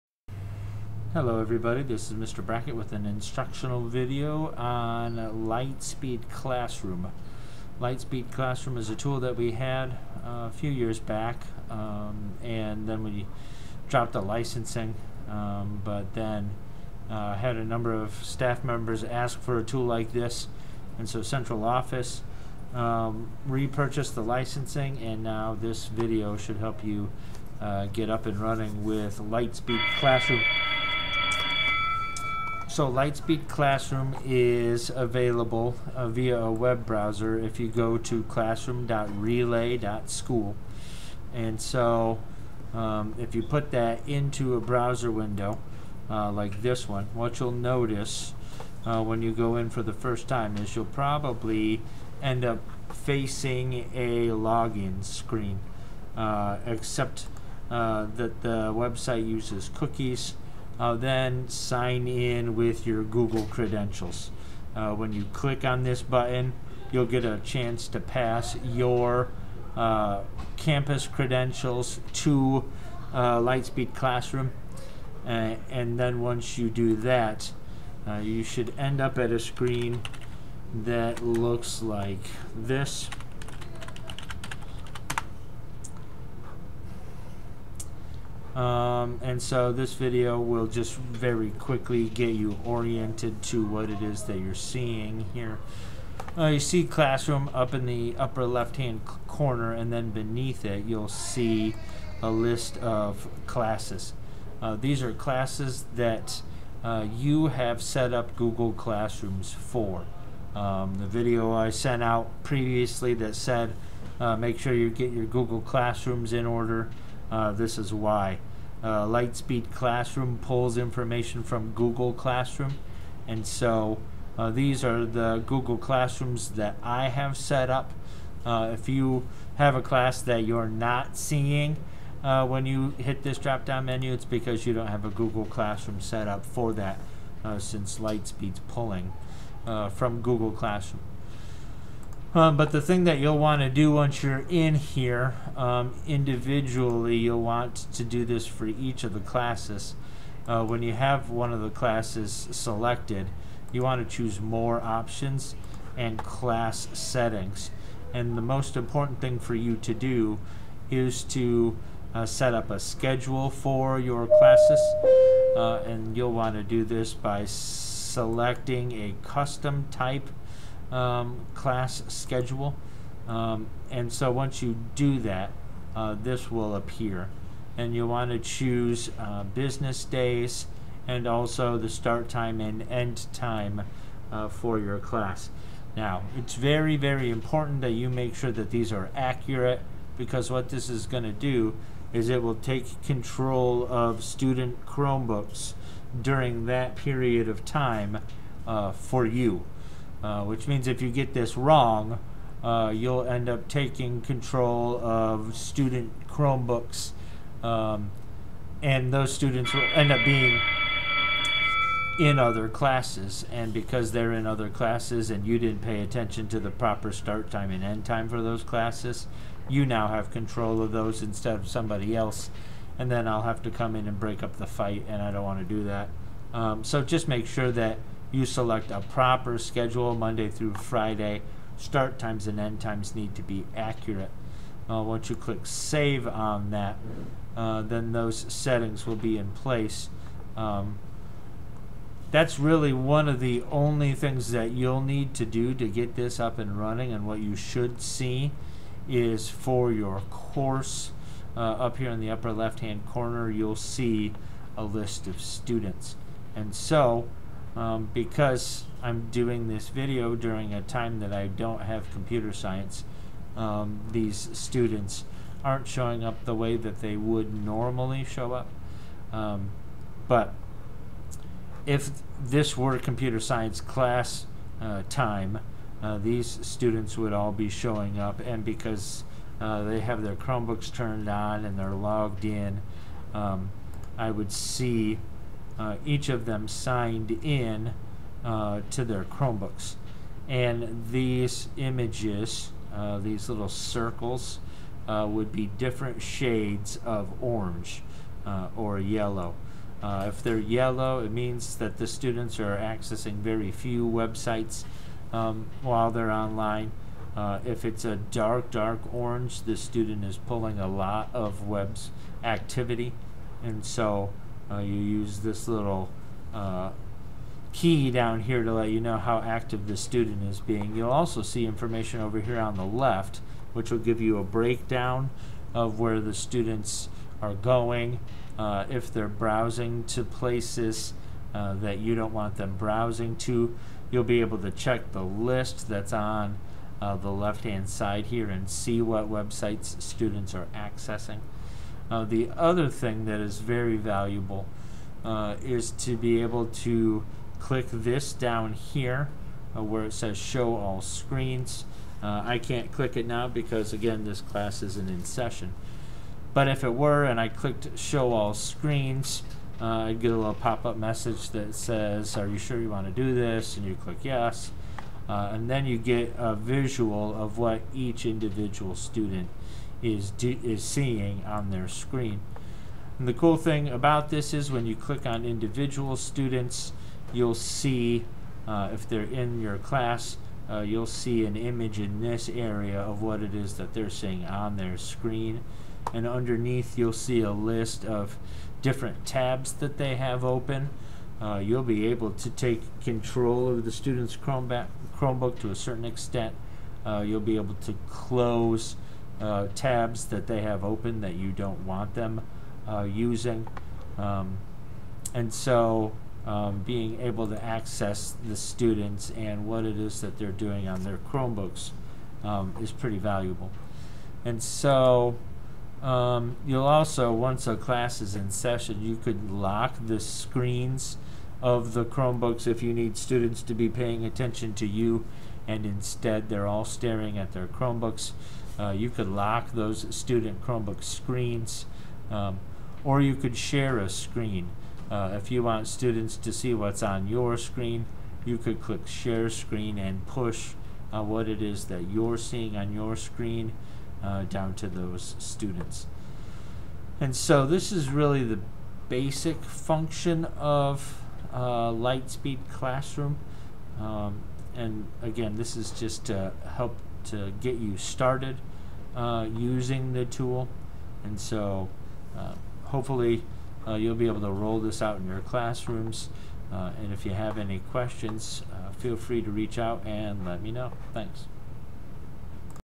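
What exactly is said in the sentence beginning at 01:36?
Uh, you see classroom up in the upper left hand corner and then beneath it you'll see a list of classes.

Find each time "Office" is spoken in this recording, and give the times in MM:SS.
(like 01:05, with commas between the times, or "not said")
00:21.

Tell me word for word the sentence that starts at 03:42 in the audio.
And then I'll have to come in and break up the fight, and I don't want to do that.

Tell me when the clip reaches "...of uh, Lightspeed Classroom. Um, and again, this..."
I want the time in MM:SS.
07:30.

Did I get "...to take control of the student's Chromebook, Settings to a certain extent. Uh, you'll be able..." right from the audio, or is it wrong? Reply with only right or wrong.
wrong.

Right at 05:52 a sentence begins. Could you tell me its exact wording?
Uh, I can't click it now because again this class isn't in session.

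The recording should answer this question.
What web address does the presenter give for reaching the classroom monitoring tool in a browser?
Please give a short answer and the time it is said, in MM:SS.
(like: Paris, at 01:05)
classroom.relay.school, at 00:38.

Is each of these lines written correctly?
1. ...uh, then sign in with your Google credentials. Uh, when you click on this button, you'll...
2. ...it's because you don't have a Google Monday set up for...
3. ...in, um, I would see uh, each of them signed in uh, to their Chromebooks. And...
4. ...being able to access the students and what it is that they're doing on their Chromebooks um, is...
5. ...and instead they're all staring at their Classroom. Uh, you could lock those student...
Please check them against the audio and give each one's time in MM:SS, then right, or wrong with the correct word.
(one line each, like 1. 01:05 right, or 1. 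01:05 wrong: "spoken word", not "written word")
1. 01:00 right
2. 02:14 wrong: "Classroom", not "Monday"
3. 04:42 right
4. 06:46 right
5. 07:05 wrong: "Chromebooks", not "Classroom".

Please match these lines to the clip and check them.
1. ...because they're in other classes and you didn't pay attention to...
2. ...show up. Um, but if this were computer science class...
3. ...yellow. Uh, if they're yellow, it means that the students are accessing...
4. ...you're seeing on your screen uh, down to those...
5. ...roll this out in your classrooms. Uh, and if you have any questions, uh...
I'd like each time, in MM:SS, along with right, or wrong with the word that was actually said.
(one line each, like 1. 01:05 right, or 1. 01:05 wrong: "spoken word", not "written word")
1. 03:33 right
2. 04:28 right
3. 04:58 right
4. 07:22 right
5. 07:44 right.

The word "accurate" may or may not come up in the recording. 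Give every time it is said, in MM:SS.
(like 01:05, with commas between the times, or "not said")
03:09, 03:53.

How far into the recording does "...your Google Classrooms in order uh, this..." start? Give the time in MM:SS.
01:55.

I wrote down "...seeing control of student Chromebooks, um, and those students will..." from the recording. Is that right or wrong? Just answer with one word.
wrong.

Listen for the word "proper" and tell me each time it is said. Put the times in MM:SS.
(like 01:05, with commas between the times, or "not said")
03:36, 03:49.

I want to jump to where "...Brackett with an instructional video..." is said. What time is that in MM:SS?
00:02.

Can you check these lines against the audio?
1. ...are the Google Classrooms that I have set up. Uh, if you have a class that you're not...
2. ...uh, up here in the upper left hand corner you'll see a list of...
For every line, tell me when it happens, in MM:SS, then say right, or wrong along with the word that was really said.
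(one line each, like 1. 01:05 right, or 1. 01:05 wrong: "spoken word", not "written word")
1. 02:04 right
2. 04:11 right.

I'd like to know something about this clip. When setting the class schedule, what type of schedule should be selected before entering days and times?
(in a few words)
custom.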